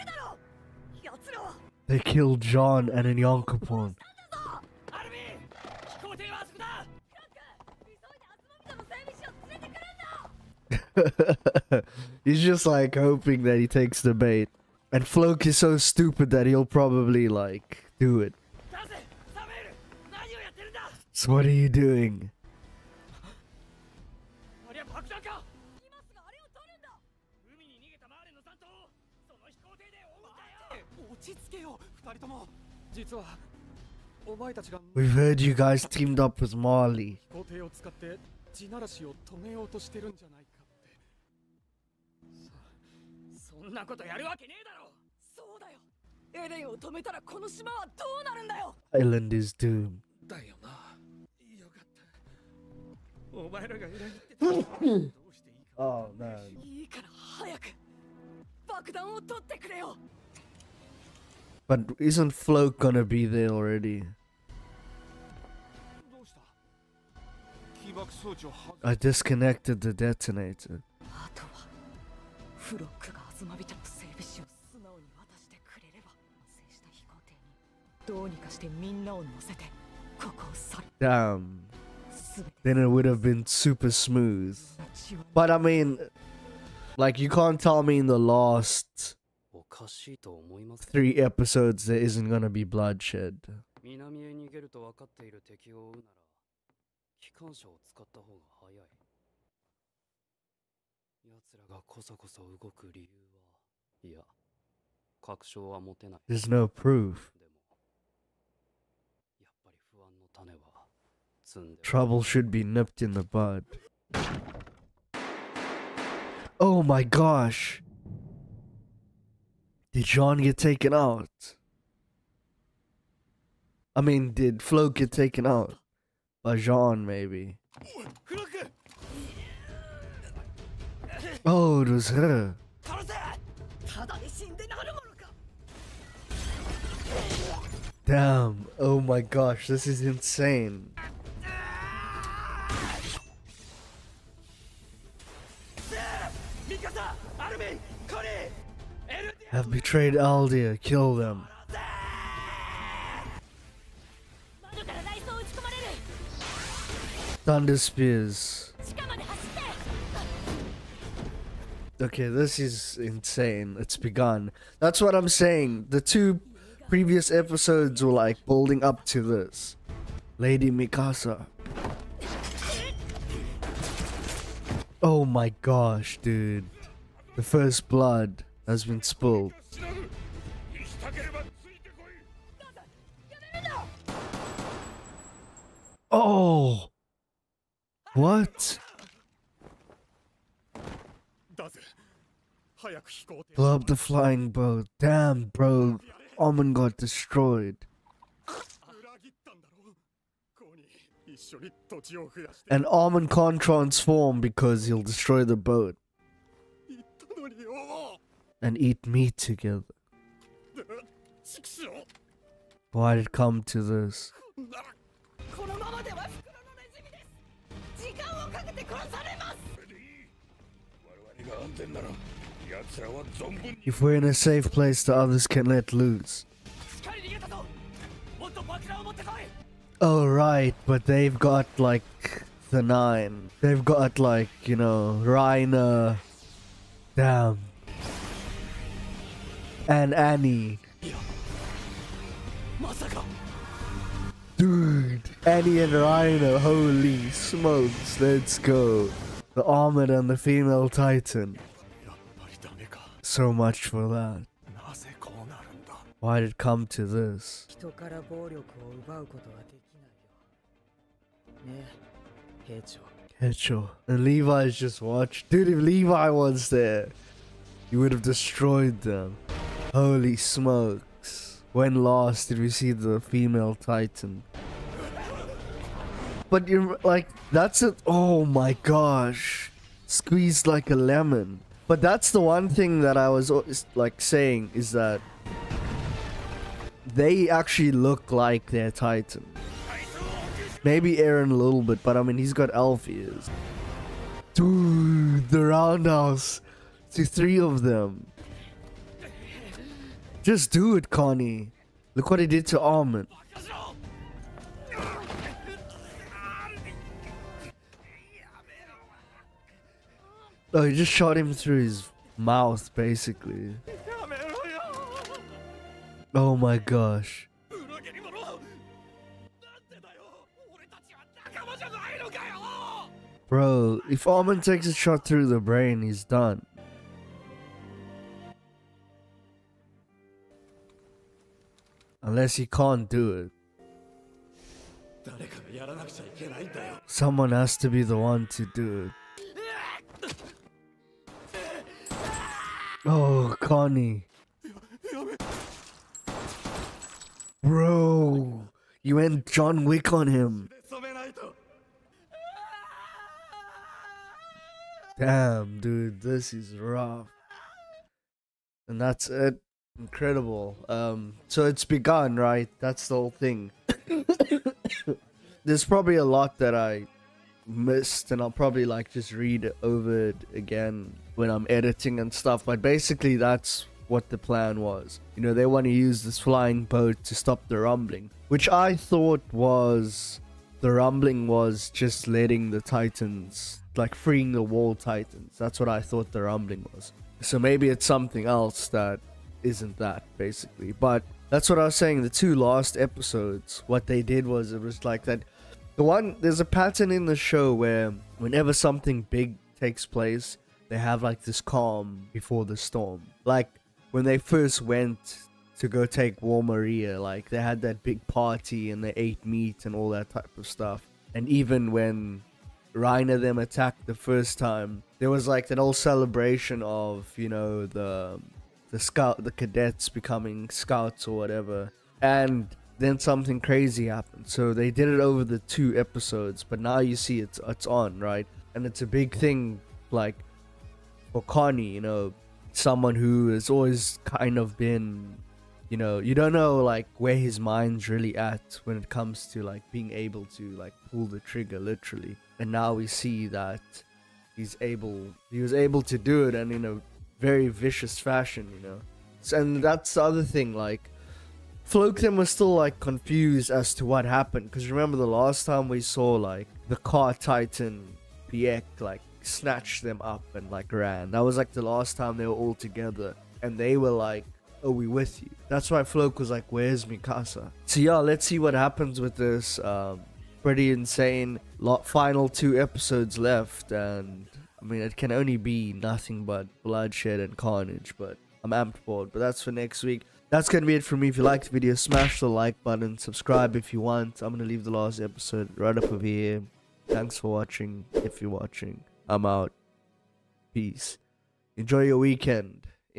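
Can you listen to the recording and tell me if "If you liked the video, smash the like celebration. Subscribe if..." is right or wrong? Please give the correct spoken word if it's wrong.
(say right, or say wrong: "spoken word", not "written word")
wrong: "button", not "celebration".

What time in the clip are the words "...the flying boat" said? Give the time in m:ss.
3:13.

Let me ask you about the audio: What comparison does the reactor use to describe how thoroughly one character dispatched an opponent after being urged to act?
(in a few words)
John Wick.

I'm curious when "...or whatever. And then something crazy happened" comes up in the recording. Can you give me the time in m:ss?
7:01.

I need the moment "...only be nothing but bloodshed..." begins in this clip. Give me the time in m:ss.
7:55.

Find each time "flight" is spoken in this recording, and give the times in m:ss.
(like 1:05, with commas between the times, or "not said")
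not said.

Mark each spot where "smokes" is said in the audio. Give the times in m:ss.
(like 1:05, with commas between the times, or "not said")
4:07, 4:30.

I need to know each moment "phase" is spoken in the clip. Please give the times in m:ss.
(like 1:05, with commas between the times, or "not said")
not said.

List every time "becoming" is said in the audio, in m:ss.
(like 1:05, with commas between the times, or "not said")
7:00.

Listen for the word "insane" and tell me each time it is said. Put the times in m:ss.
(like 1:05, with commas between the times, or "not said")
2:20, 2:43, 7:50.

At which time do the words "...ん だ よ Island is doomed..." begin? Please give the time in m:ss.
0:48.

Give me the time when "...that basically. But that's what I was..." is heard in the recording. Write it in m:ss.
6:29.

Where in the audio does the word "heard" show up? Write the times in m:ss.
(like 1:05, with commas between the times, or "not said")
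0:35.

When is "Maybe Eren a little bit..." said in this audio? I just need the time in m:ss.
4:50.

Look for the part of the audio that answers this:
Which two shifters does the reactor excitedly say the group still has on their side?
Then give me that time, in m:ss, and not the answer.
4:05.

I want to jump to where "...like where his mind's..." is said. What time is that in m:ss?
7:16.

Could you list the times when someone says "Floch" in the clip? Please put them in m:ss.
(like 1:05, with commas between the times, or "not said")
0:15, 7:46.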